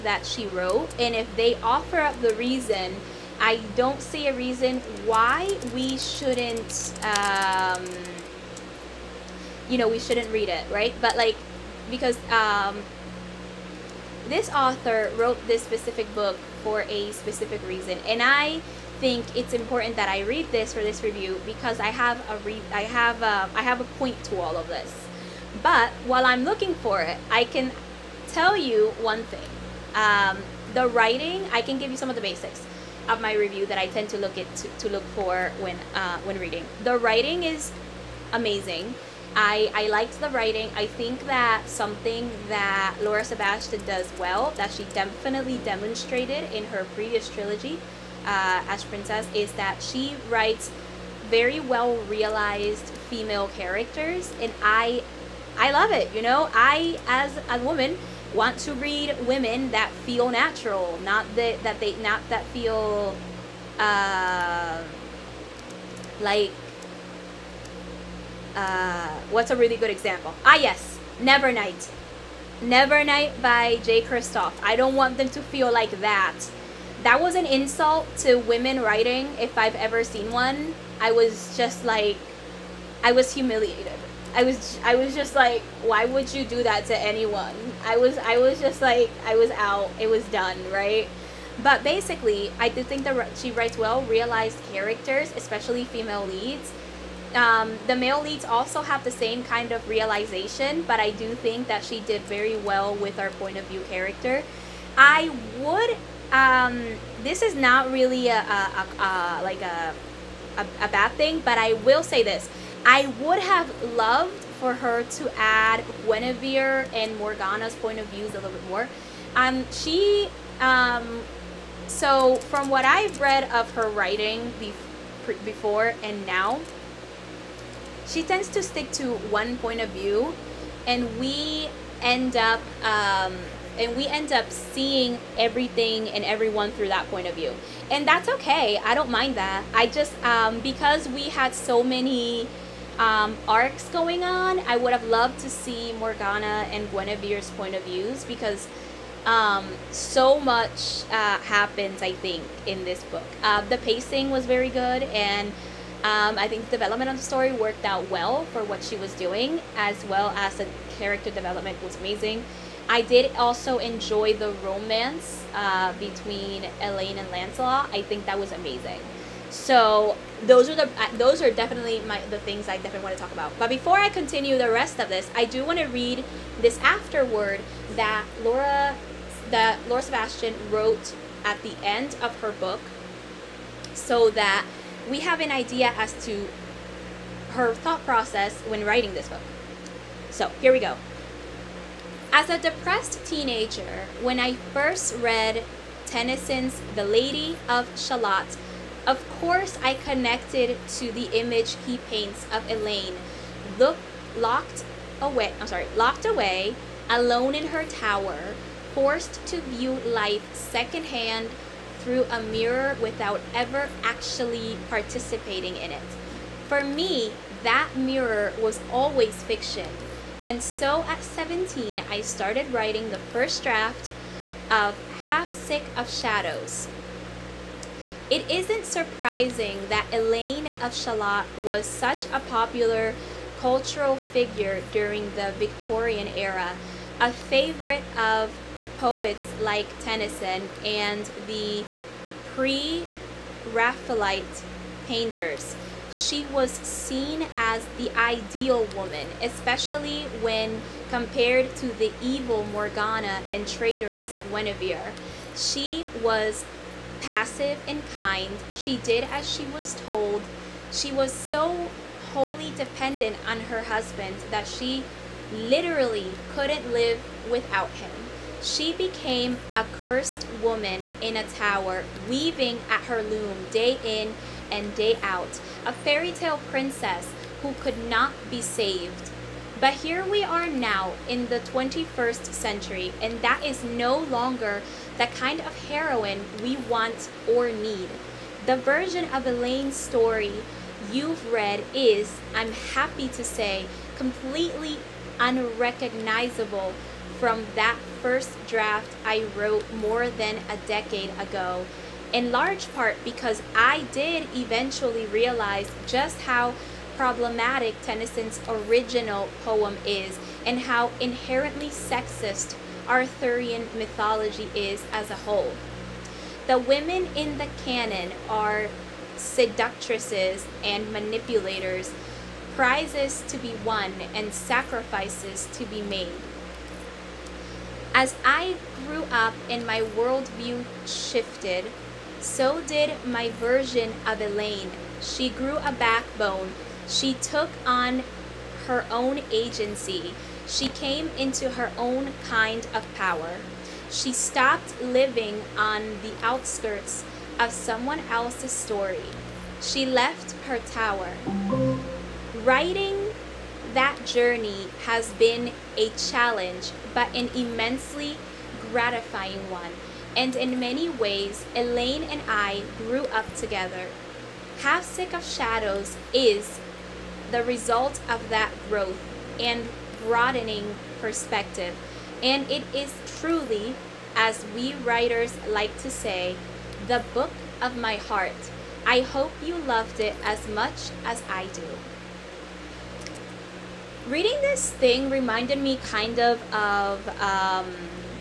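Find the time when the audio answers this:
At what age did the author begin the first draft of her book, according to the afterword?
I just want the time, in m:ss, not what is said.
3:41.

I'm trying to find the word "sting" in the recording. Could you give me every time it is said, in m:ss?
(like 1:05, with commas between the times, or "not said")
not said.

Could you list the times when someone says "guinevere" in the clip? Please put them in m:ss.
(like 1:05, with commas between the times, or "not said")
1:56, 2:26, 4:14.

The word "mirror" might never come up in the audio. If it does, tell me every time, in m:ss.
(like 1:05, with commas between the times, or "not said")
3:32, 3:37.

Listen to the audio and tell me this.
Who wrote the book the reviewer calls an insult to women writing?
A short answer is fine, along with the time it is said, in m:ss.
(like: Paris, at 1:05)
Jay Kristoff, at 1:13.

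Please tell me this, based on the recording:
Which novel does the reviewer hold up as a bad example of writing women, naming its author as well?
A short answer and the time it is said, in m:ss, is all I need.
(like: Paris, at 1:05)
Nevernight, at 1:12.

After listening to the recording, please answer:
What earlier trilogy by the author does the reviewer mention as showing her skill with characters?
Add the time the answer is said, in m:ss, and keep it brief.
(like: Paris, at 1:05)
Ash Princess, at 0:48.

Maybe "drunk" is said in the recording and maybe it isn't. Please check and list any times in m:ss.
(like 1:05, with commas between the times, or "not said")
not said.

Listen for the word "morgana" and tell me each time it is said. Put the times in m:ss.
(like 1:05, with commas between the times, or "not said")
1:57, 2:25, 4:12.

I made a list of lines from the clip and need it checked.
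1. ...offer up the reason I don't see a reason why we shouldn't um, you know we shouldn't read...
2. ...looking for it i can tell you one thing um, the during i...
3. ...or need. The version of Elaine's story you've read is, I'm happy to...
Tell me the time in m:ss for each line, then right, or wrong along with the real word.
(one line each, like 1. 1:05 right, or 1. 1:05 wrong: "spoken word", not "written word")
1. 0:01 right
2. 0:26 wrong: "writing", not "during"
3. 4:47 right.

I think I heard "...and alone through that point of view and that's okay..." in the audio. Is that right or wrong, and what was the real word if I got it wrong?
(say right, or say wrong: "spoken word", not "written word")
wrong: "everyone", not "alone".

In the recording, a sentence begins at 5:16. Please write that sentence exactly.
The women in the canon are seductresses and manipulators, prizes to be won and sacrifices to be made.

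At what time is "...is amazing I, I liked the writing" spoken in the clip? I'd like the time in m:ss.
0:37.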